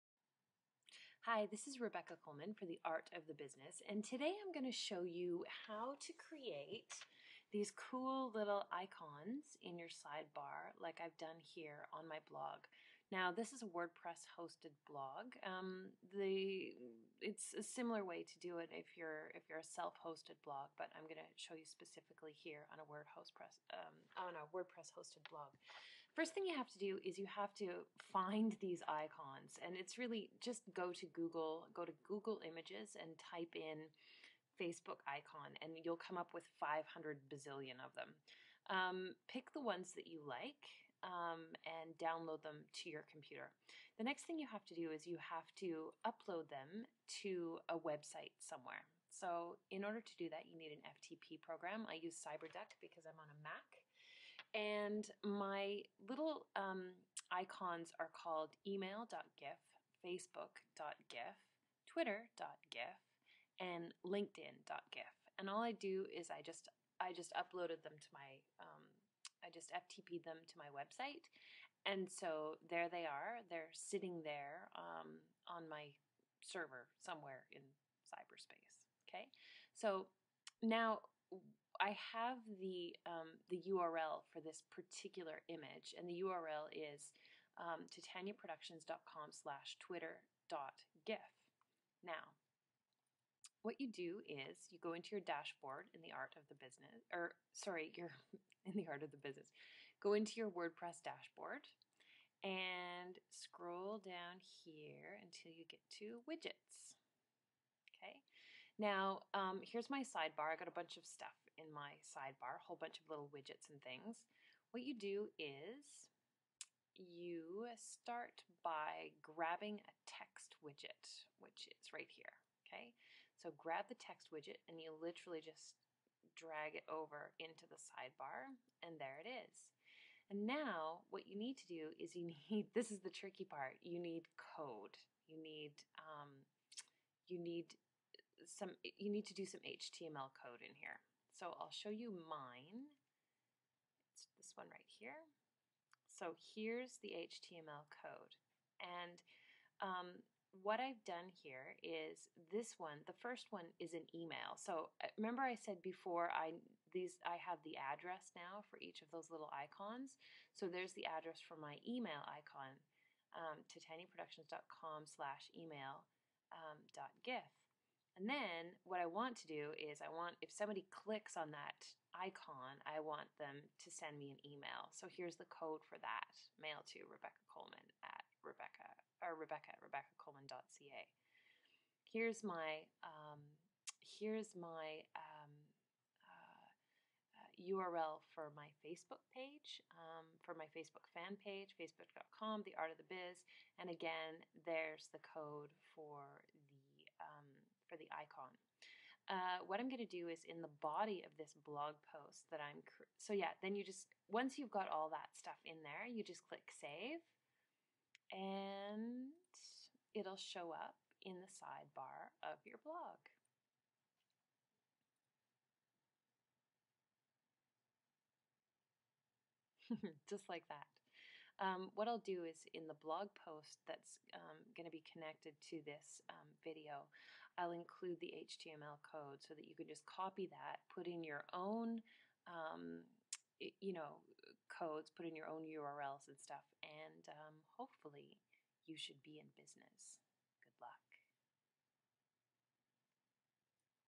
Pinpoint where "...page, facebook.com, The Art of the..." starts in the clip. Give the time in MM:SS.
03:11.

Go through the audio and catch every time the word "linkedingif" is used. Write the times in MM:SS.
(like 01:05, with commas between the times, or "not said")
01:04.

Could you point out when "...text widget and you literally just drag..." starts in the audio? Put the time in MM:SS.
02:04.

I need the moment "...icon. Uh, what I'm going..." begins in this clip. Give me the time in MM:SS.
03:18.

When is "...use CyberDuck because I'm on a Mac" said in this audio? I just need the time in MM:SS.
00:52.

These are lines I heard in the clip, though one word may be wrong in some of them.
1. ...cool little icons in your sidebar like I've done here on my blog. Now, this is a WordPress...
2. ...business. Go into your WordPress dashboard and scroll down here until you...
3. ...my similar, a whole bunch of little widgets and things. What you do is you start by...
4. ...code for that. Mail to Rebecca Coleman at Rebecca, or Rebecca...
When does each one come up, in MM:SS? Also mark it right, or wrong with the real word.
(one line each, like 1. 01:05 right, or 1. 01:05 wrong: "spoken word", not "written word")
1. 00:07 right
2. 01:39 right
3. 01:51 wrong: "sidebar", not "similar"
4. 02:55 right.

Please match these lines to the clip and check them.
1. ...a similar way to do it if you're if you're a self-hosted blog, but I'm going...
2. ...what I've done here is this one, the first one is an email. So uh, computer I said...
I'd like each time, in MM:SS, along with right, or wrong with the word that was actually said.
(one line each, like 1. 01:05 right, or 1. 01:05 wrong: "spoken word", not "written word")
1. 00:17 right
2. 02:30 wrong: "remember", not "computer".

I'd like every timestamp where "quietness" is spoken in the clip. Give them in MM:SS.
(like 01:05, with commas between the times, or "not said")
not said.